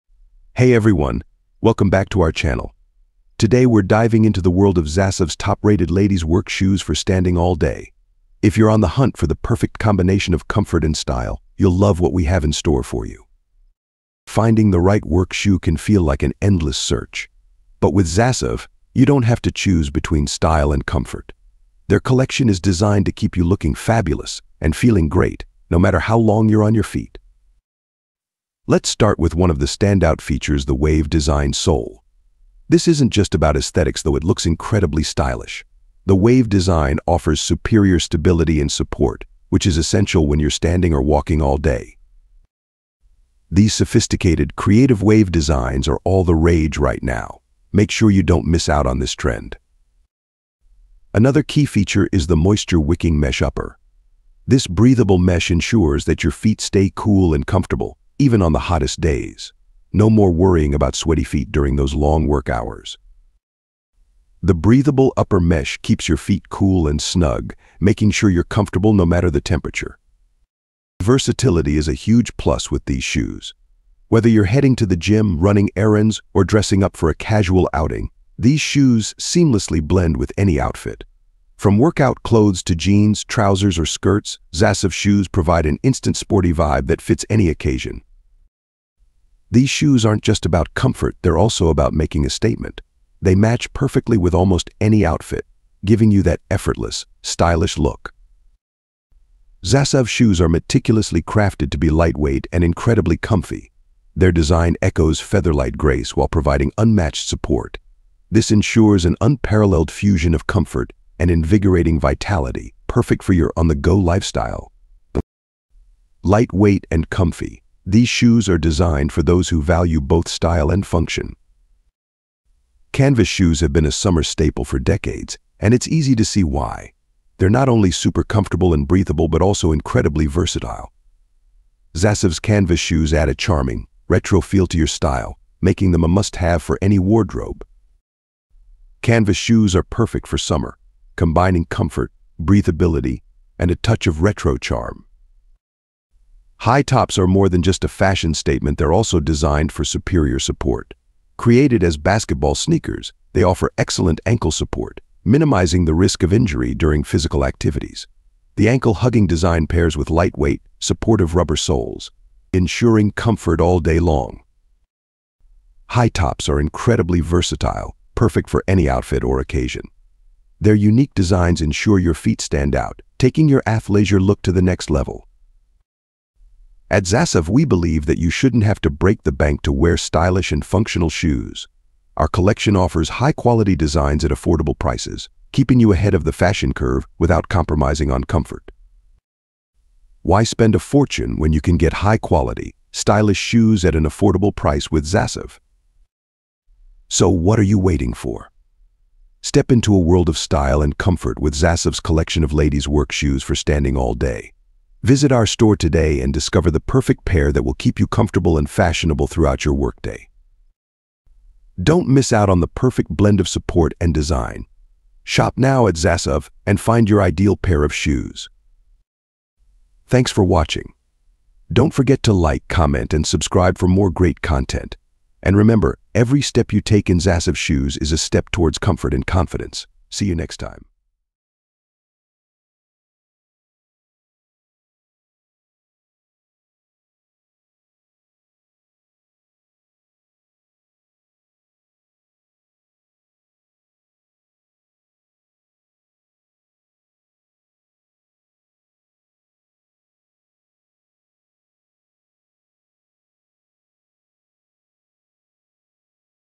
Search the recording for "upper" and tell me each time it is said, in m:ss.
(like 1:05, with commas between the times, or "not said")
0:53, 1:05.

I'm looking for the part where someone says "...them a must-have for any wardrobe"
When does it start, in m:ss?
2:15.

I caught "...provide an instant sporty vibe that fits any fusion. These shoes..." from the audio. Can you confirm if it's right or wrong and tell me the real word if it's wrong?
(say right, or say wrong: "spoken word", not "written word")
wrong: "occasion", not "fusion".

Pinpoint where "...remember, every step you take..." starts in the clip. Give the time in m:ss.
3:45.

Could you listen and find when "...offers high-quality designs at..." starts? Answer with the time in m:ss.
3:02.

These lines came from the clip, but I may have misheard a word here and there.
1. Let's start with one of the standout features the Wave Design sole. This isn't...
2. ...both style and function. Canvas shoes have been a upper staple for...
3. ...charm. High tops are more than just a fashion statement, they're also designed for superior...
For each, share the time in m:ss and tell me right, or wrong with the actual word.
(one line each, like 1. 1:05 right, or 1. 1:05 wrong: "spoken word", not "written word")
1. 0:28 right
2. 2:00 wrong: "summer", not "upper"
3. 2:24 right.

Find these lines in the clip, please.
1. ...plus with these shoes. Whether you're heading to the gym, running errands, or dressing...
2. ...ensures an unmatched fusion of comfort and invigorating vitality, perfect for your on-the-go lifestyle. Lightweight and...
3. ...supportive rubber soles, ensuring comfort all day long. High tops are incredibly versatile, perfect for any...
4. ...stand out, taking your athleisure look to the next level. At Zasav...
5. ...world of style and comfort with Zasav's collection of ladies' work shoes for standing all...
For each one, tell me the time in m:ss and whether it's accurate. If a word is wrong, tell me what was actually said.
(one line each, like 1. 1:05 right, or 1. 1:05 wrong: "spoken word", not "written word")
1. 1:12 right
2. 1:48 wrong: "unparalleled", not "unmatched"
3. 2:40 right
4. 2:52 right
5. 3:20 right.